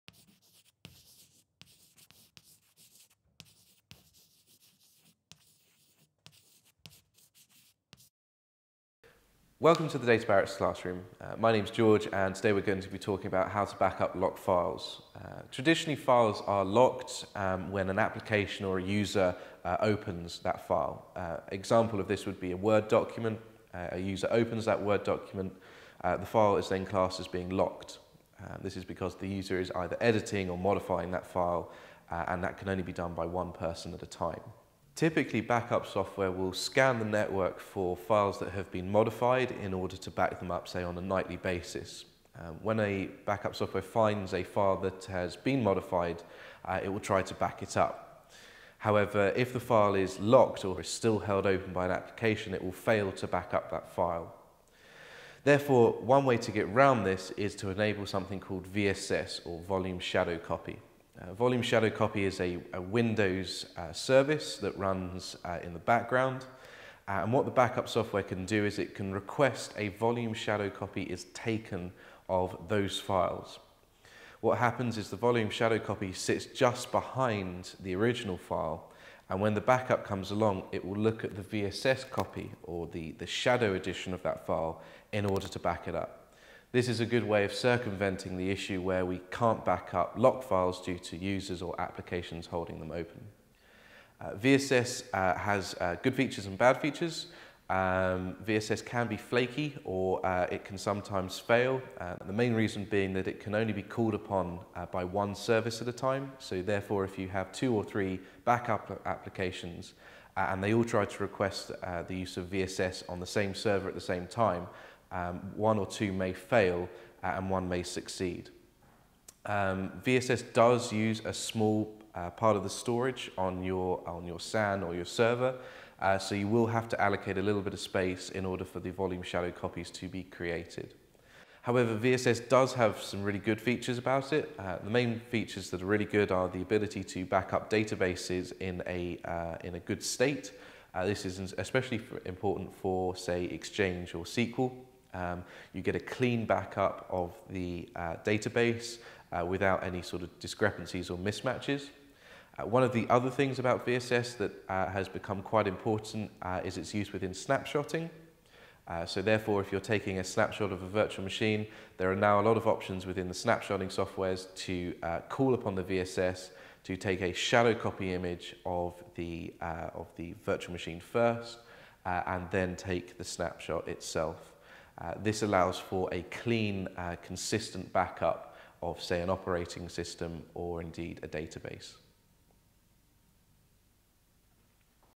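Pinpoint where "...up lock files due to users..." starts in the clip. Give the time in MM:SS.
01:29.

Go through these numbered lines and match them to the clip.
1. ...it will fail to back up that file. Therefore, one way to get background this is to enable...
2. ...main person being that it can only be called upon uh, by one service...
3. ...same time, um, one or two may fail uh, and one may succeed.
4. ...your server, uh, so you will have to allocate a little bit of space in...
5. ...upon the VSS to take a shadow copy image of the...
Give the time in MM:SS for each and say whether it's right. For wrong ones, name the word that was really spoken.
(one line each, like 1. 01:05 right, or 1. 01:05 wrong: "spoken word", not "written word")
1. 00:52 wrong: "round", not "background"
2. 01:42 wrong: "reason", not "person"
3. 01:54 right
4. 02:04 right
5. 02:45 right.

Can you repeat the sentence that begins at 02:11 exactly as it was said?
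However, VSS does have some really good features about it.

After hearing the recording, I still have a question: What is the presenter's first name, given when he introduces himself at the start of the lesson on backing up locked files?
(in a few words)
George.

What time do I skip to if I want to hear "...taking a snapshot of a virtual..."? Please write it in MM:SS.
02:39.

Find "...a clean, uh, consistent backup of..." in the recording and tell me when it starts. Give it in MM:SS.
02:56.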